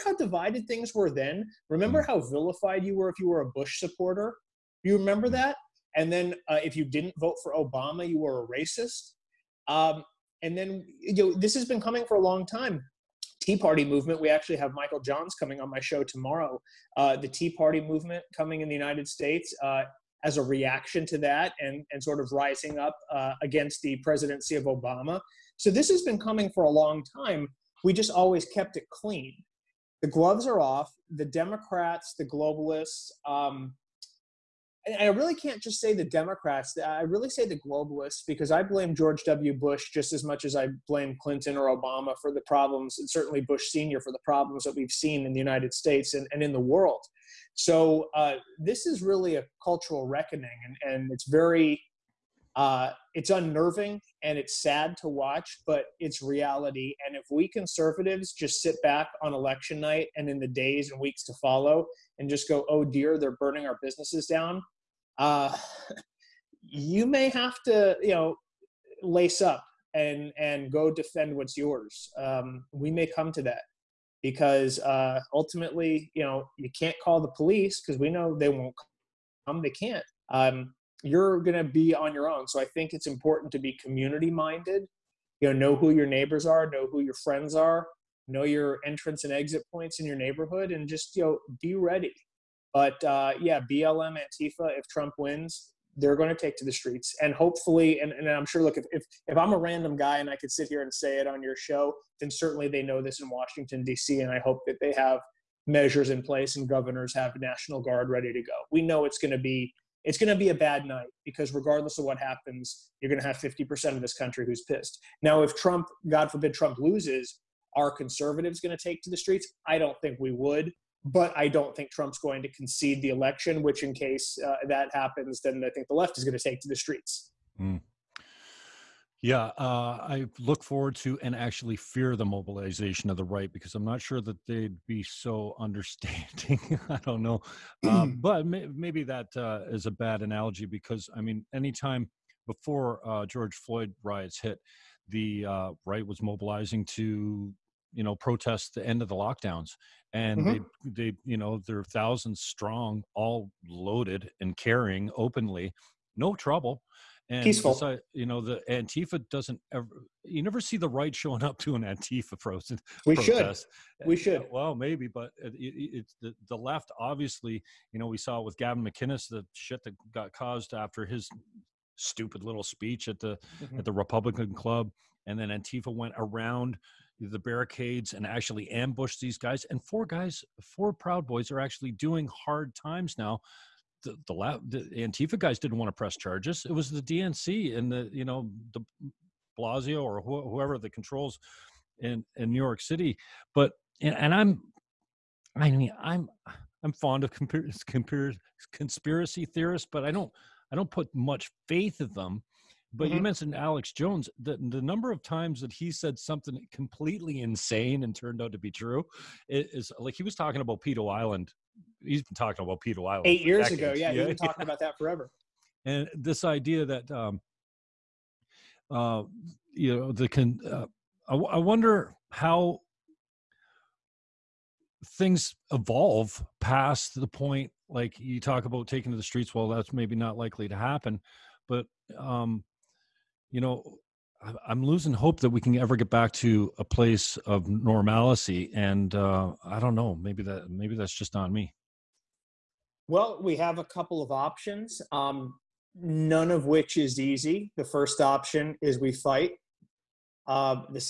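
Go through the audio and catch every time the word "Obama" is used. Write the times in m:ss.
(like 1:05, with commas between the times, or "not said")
0:07, 0:24, 0:41.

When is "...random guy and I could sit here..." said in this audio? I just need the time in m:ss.
1:39.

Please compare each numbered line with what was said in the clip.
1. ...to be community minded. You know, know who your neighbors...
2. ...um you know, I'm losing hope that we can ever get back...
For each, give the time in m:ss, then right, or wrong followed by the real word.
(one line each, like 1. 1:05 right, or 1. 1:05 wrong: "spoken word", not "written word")
1. 1:23 right
2. 3:52 right.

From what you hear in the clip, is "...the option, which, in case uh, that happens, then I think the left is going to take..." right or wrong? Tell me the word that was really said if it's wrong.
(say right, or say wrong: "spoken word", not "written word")
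wrong: "election", not "option".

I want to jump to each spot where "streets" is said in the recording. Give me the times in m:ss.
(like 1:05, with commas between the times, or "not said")
1:36, 1:59, 2:06, 3:49.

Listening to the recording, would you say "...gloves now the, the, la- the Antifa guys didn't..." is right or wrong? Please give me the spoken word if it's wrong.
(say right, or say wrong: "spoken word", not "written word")
wrong: "times", not "gloves".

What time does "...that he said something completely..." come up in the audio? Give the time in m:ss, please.
3:25.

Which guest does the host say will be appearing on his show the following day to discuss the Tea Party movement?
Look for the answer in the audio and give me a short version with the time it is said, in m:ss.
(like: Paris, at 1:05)
Michael Johns, at 0:14.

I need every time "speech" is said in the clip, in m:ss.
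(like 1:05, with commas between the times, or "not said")
2:52.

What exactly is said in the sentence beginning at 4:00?
Maybe that maybe that's just on me.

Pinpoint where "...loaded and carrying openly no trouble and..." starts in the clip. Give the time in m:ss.
2:33.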